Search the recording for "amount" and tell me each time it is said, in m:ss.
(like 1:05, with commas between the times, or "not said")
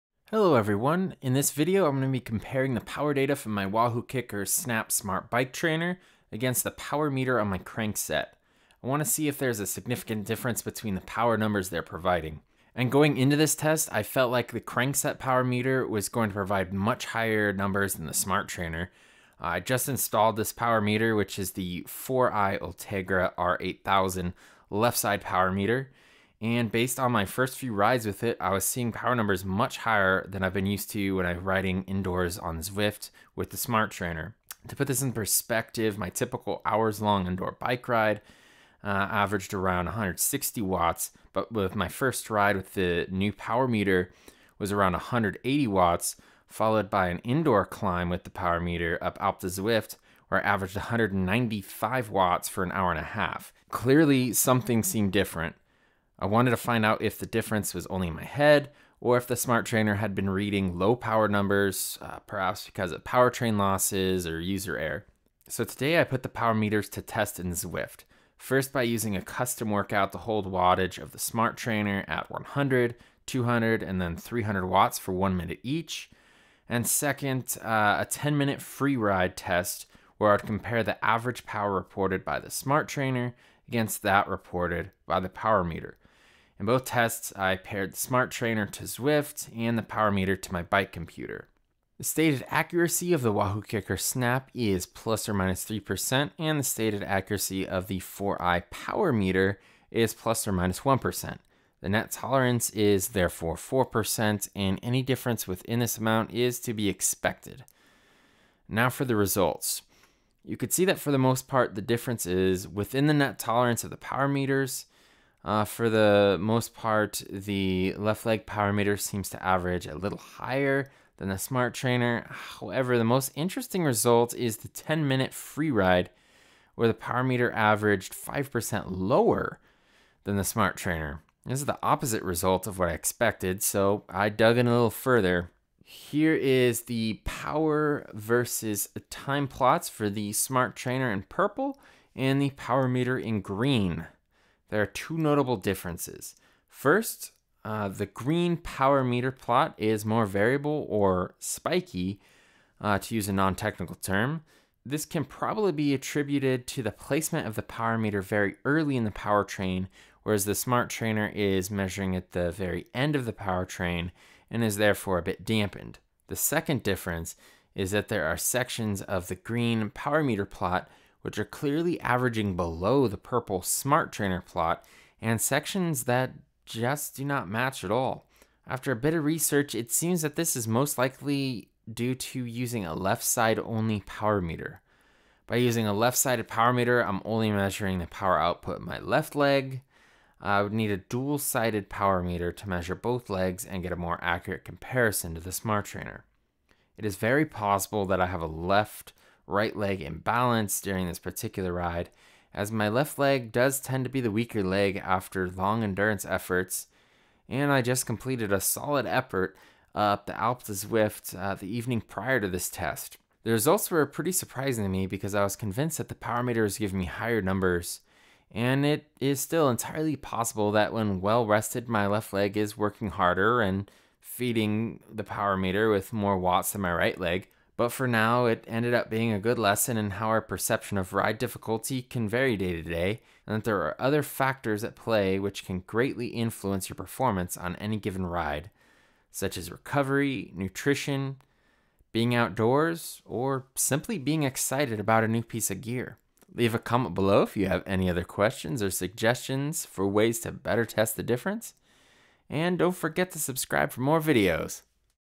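1:45.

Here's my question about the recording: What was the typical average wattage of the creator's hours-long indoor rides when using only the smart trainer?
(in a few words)
160 watts.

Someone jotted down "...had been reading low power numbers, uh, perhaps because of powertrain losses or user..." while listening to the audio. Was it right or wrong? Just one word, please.
right.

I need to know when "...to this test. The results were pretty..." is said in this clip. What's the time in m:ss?
3:32.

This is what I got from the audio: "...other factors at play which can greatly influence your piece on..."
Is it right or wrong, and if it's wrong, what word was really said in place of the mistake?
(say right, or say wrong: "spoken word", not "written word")
wrong: "performance", not "piece".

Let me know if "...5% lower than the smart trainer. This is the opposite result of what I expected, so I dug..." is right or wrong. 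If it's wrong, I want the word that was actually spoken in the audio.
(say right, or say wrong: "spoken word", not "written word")
right.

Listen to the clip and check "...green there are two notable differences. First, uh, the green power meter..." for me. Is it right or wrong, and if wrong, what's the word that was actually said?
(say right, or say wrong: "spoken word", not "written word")
right.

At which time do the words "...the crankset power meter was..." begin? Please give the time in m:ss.
0:14.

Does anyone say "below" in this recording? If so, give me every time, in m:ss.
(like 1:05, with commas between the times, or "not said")
2:52, 4:07.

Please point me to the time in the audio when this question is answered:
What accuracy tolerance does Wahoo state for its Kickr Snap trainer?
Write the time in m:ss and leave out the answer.
1:34.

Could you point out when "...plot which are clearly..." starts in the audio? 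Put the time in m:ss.
2:50.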